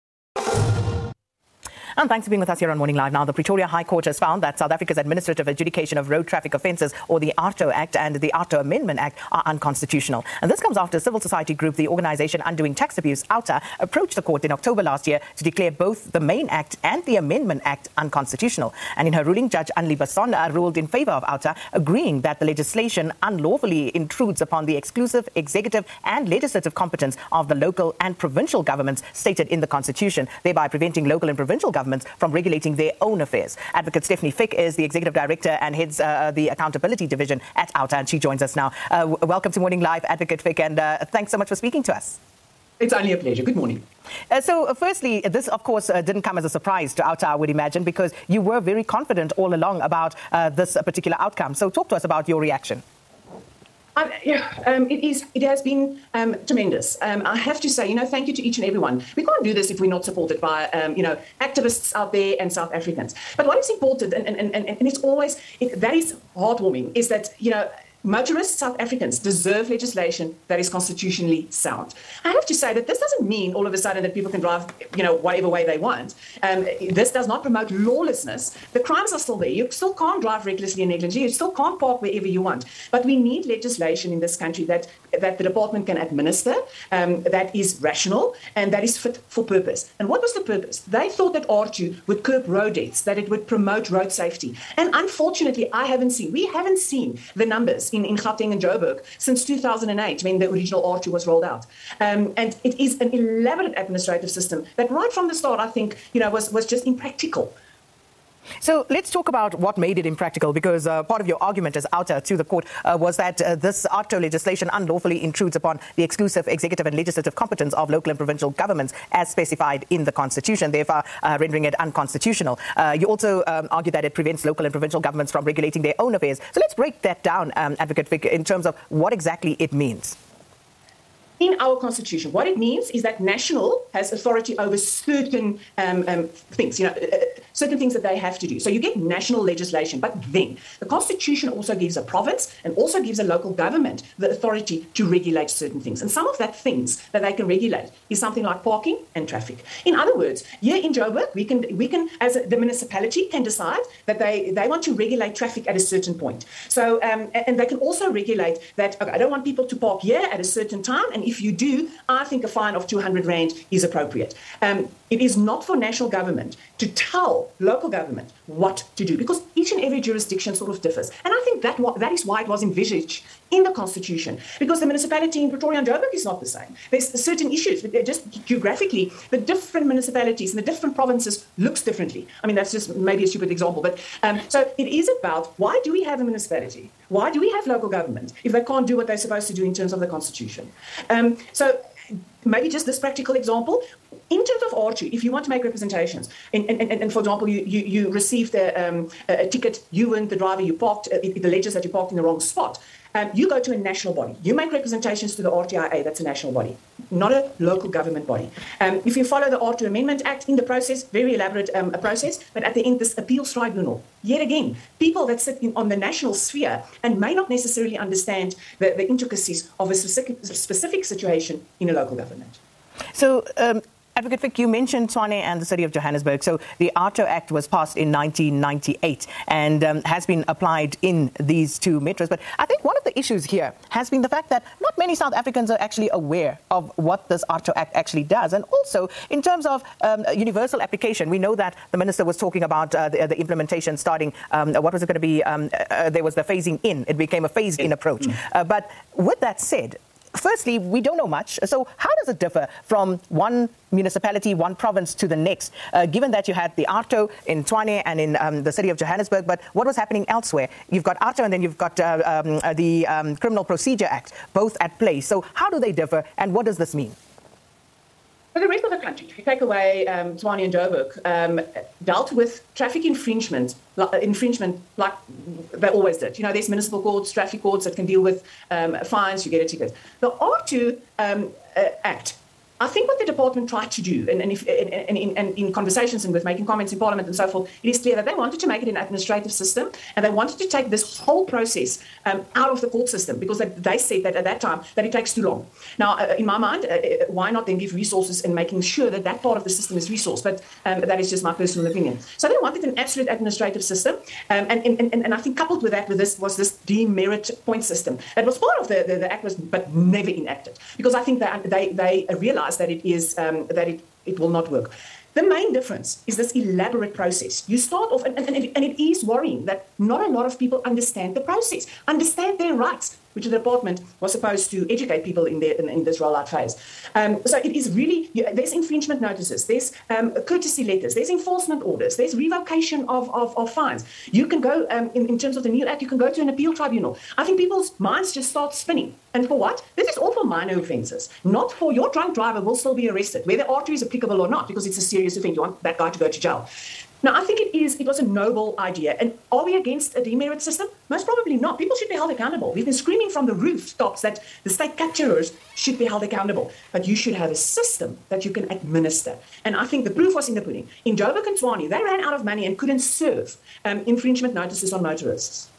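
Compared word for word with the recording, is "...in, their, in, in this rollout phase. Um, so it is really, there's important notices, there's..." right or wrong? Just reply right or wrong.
wrong.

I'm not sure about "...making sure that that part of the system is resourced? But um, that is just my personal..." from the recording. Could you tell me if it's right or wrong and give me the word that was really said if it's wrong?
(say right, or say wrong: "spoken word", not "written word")
right.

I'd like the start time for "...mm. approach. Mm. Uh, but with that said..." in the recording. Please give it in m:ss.
4:07.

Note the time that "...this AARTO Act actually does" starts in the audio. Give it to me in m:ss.
3:57.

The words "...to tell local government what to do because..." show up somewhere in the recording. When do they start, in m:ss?
2:46.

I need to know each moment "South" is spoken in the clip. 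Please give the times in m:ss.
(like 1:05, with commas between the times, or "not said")
0:04, 1:02, 1:08, 3:55.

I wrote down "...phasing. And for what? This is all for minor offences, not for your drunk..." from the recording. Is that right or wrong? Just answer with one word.
wrong.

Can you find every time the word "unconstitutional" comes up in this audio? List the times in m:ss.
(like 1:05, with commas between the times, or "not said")
0:09, 0:17, 2:01.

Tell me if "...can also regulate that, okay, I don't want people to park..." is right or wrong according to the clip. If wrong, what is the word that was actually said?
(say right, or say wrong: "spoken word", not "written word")
right.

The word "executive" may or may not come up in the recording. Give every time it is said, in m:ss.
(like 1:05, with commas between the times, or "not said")
0:25, 0:34, 1:56.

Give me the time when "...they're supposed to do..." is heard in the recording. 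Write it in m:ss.
3:09.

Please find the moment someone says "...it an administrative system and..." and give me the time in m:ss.
4:48.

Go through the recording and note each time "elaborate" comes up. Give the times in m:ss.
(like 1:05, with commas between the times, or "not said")
1:43, 3:31, 5:16.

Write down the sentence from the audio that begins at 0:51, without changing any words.
So, talk to us about your reaction.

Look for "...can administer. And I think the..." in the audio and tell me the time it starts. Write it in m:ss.
5:58.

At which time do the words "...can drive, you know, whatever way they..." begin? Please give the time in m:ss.
1:14.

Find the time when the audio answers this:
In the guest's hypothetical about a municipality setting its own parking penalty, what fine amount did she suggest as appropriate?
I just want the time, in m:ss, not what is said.
2:42.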